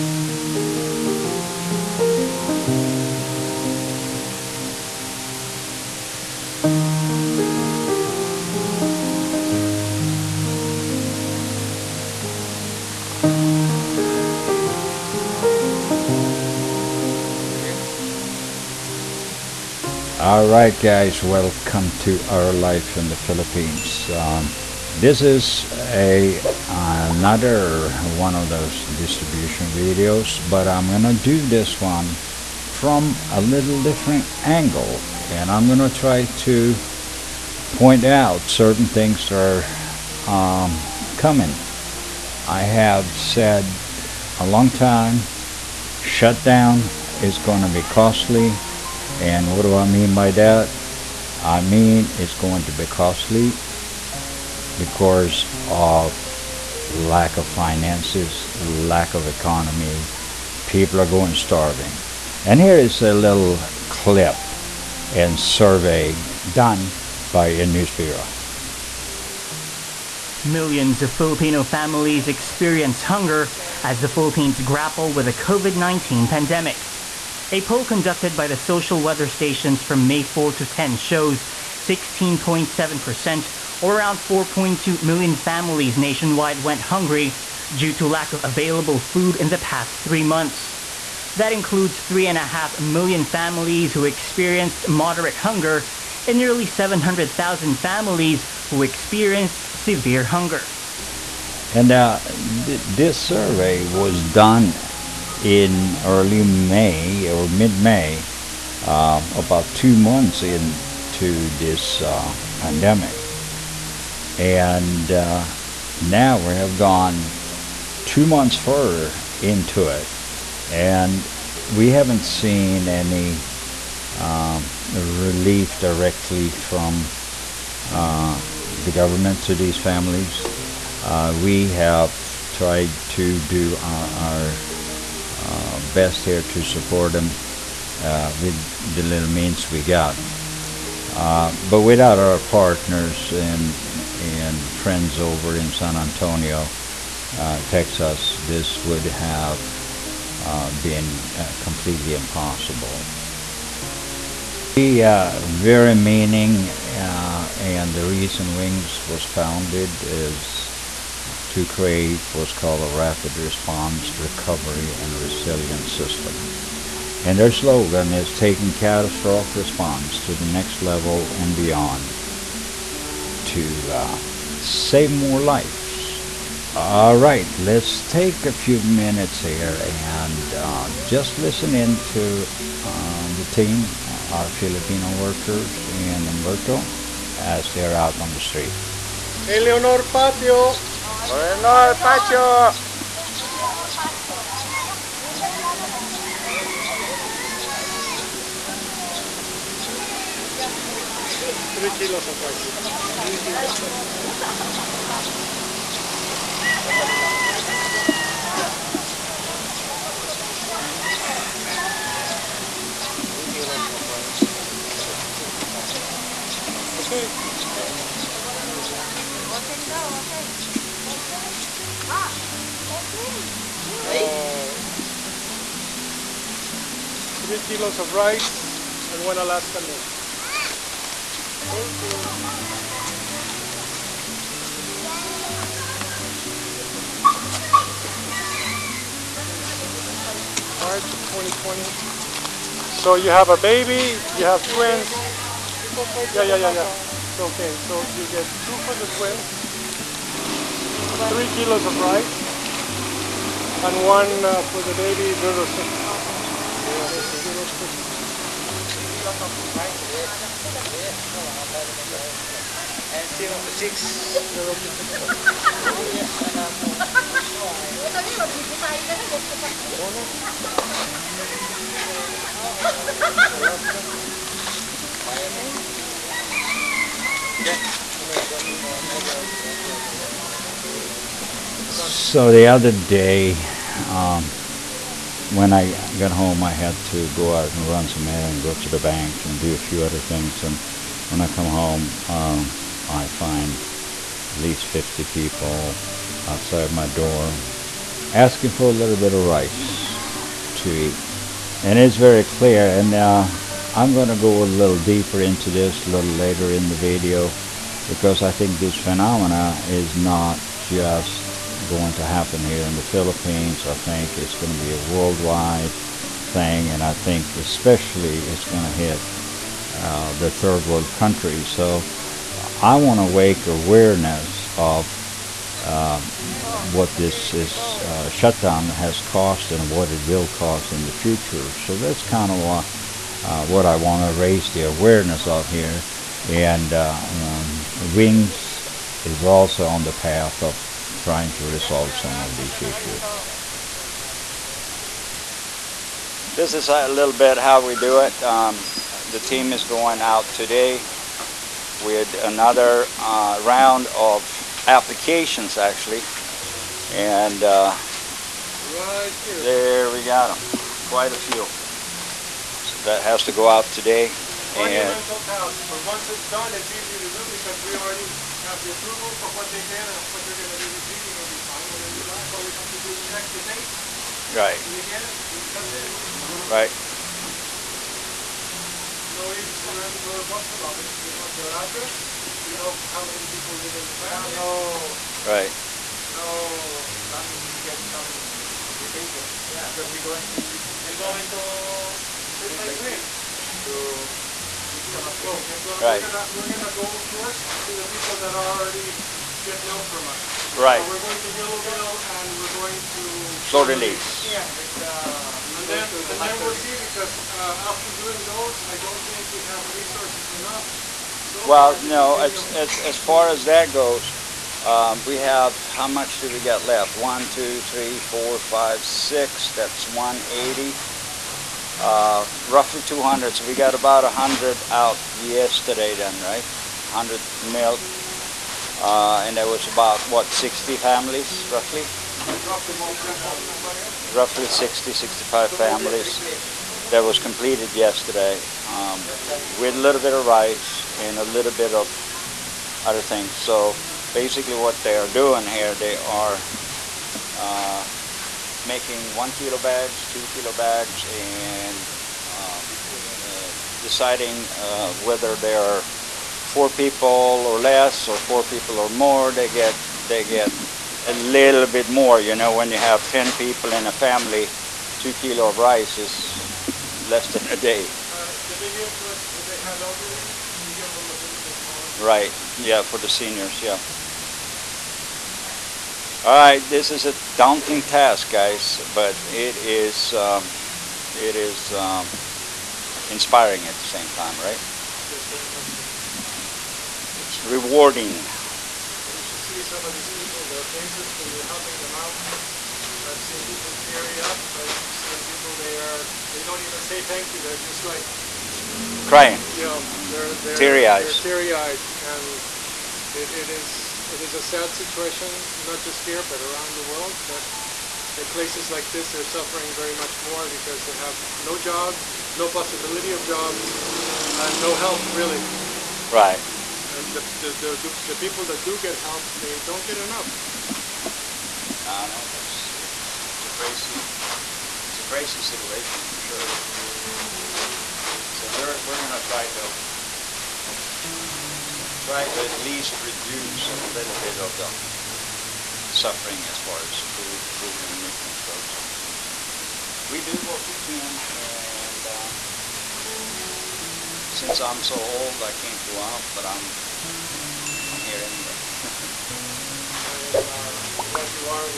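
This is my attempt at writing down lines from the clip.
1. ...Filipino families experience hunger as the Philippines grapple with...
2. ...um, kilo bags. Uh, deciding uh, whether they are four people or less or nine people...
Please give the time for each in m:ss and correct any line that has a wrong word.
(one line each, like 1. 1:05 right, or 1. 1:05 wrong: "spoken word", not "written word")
1. 1:11 right
2. 7:32 wrong: "four", not "nine".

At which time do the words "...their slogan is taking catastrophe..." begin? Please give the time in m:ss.
2:47.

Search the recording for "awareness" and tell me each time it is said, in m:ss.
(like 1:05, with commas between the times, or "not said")
5:23, 5:34.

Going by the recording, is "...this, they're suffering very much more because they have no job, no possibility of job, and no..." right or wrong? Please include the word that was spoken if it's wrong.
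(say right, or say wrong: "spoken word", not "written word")
right.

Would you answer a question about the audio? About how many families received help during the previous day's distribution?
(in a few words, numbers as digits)
60 to 65.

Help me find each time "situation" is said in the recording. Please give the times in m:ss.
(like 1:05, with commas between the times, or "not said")
8:24, 8:45.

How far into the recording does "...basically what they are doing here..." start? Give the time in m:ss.
7:24.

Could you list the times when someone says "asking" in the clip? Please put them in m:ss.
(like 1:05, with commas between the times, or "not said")
4:58.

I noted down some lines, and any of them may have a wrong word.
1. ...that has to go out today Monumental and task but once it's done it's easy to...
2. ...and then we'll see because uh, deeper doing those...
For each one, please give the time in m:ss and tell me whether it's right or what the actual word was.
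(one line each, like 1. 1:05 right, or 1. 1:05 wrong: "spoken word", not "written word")
1. 6:03 right
2. 6:46 wrong: "after", not "deeper".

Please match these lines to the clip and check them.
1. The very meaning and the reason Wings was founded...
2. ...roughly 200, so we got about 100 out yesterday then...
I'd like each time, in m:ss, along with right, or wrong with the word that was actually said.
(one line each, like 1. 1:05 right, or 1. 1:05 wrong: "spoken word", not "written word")
1. 2:34 right
2. 7:02 right.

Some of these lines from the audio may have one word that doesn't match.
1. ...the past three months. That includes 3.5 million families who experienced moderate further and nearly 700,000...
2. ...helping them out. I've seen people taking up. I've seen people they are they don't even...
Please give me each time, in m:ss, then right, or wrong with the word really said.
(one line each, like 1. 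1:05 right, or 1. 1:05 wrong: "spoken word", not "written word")
1. 1:29 wrong: "hunger", not "further"
2. 8:11 wrong: "tearing", not "taking".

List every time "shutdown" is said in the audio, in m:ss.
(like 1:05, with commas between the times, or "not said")
0:46, 5:28.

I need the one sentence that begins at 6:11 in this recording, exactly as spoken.
And then you're like, all we have to do is check the date.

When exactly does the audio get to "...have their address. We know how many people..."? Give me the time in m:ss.
6:21.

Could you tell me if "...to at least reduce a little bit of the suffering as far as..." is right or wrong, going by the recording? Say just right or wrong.
right.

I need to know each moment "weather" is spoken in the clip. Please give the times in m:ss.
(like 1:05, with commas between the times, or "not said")
1:19.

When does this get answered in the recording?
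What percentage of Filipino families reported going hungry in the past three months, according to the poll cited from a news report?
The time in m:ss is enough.
1:21.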